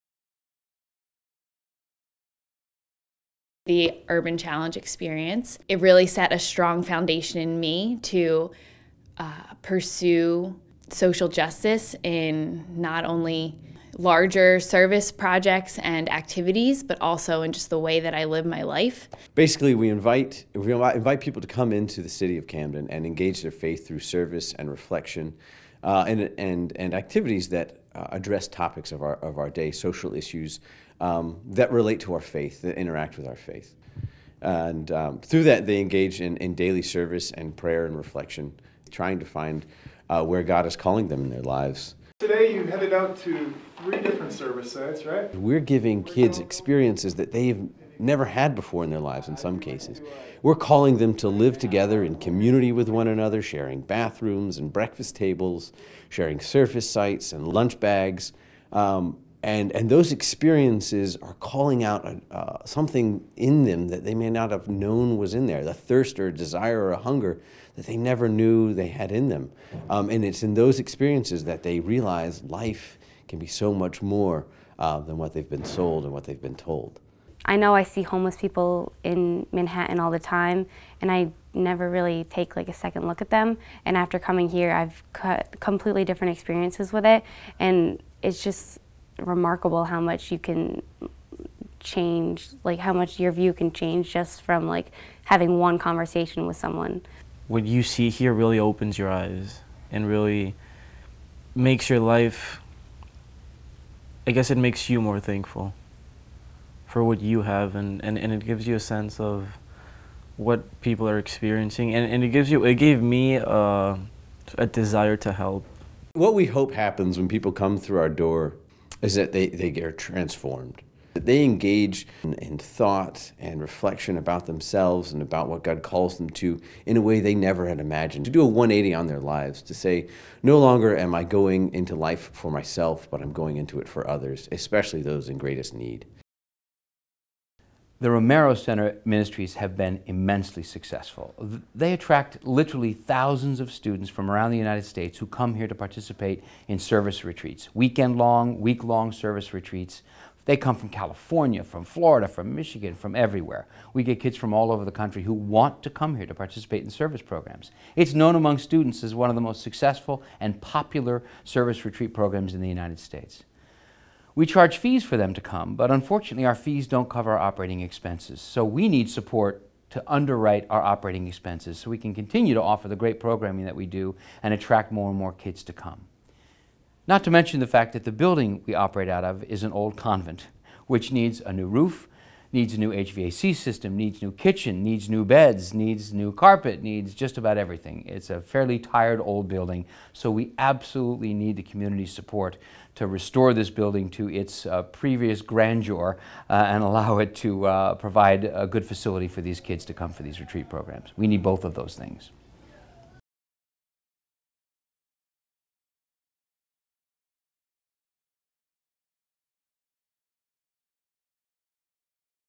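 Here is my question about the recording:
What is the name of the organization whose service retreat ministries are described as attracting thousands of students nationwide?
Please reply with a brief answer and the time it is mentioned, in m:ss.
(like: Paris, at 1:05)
Romero Center, at 2:18.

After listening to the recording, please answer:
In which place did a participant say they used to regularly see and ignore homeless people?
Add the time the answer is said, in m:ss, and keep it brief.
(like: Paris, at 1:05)
Manhattan, at 1:19.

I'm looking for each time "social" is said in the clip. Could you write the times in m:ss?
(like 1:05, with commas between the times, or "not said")
0:10, 0:29.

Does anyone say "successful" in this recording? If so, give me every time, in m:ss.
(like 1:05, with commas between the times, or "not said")
2:20, 2:39.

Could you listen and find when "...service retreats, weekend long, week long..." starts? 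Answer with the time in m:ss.
2:26.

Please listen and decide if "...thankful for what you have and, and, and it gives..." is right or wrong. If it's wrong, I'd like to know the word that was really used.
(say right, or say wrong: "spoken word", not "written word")
right.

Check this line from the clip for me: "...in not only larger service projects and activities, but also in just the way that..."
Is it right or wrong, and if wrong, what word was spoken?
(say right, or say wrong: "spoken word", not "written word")
right.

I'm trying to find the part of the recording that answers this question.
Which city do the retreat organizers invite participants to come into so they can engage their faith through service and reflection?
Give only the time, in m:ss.
0:22.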